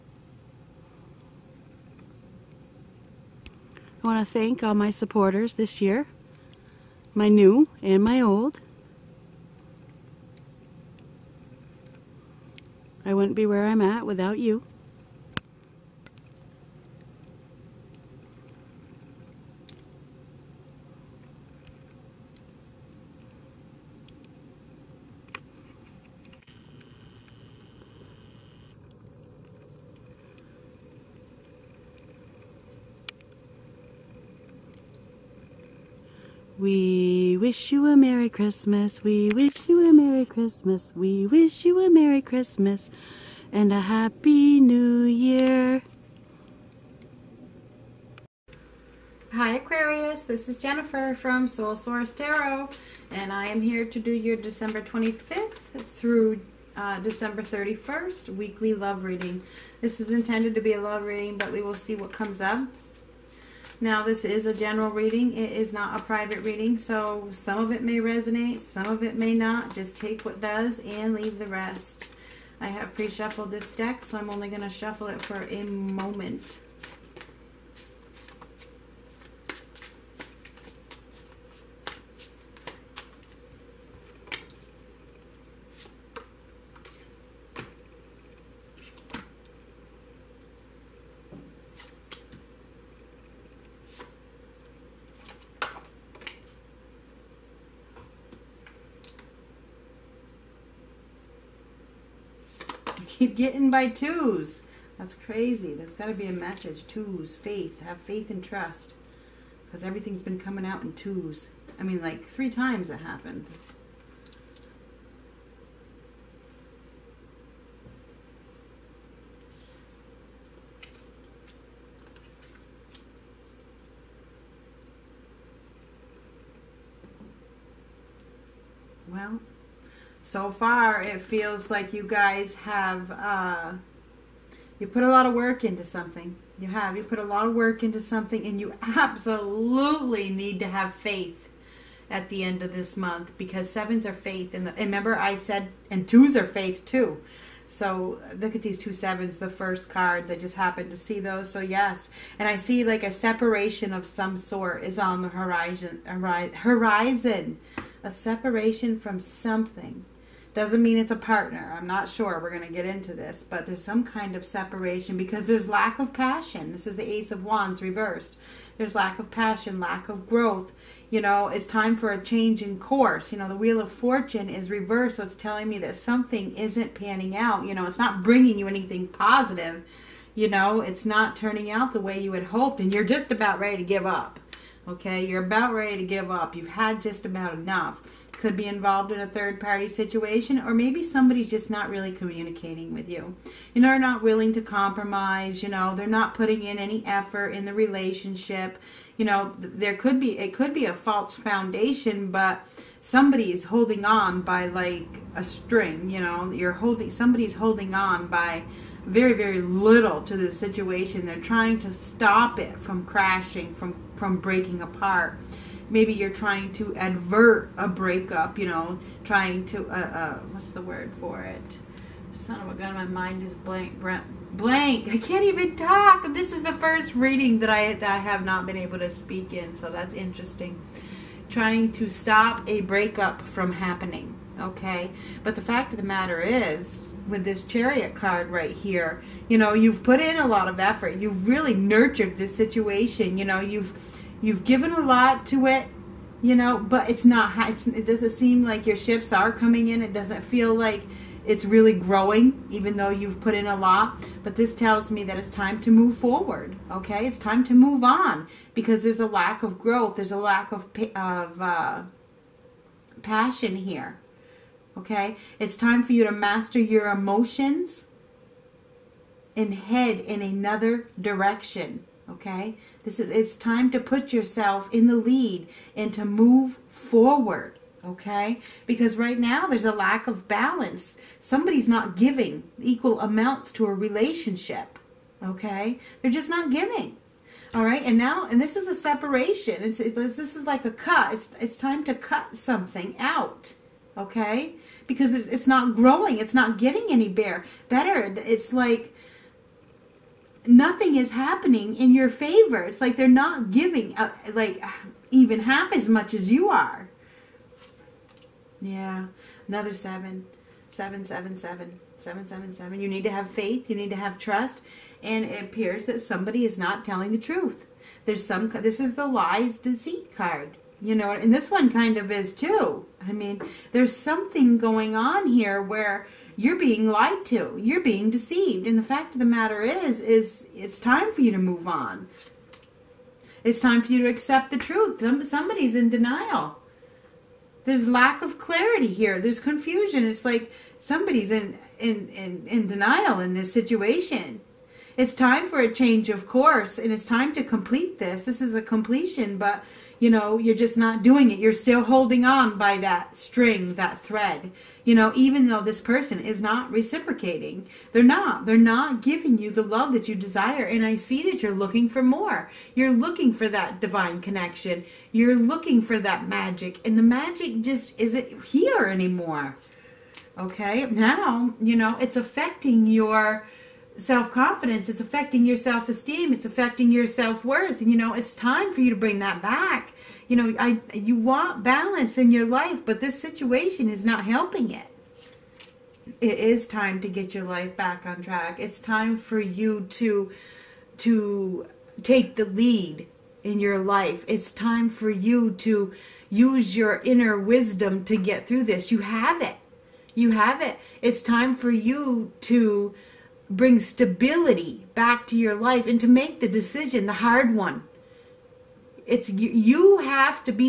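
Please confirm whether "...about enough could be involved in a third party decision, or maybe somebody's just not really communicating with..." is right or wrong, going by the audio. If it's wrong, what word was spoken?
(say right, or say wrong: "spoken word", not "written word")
wrong: "situation", not "decision".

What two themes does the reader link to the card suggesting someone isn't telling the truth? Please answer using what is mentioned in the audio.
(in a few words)
lies, deceit.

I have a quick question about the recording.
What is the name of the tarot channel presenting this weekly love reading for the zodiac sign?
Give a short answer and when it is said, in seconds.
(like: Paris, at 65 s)
Soul Source Tarot, at 51 s.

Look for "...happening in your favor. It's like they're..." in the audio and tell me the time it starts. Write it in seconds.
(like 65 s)
301 s.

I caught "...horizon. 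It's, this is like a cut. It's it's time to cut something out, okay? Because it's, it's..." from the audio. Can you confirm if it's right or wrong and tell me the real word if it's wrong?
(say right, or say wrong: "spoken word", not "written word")
wrong: "separation", not "horizon".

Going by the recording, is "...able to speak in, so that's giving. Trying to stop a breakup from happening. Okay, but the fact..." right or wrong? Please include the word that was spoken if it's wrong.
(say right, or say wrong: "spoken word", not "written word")
wrong: "interesting", not "giving".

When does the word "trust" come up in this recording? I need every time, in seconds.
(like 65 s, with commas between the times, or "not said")
108 s, 314 s.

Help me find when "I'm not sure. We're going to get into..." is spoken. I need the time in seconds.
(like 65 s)
161 s.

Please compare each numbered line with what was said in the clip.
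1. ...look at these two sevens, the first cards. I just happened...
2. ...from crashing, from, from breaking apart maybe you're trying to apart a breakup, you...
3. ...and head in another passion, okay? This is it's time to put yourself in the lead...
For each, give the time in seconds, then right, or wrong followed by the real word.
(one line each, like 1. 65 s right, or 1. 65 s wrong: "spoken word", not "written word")
1. 148 s right
2. 212 s wrong: "advert", not "apart"
3. 269 s wrong: "direction", not "passion".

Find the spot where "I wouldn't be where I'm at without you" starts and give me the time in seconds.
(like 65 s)
13 s.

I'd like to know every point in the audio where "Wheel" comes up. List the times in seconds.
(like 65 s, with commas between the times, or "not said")
173 s.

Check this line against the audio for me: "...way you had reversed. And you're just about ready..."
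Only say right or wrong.
wrong.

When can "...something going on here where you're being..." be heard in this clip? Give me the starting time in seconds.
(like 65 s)
324 s.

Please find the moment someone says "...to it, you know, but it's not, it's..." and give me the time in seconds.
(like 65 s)
245 s.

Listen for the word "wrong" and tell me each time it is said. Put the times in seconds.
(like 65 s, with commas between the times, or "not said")
not said.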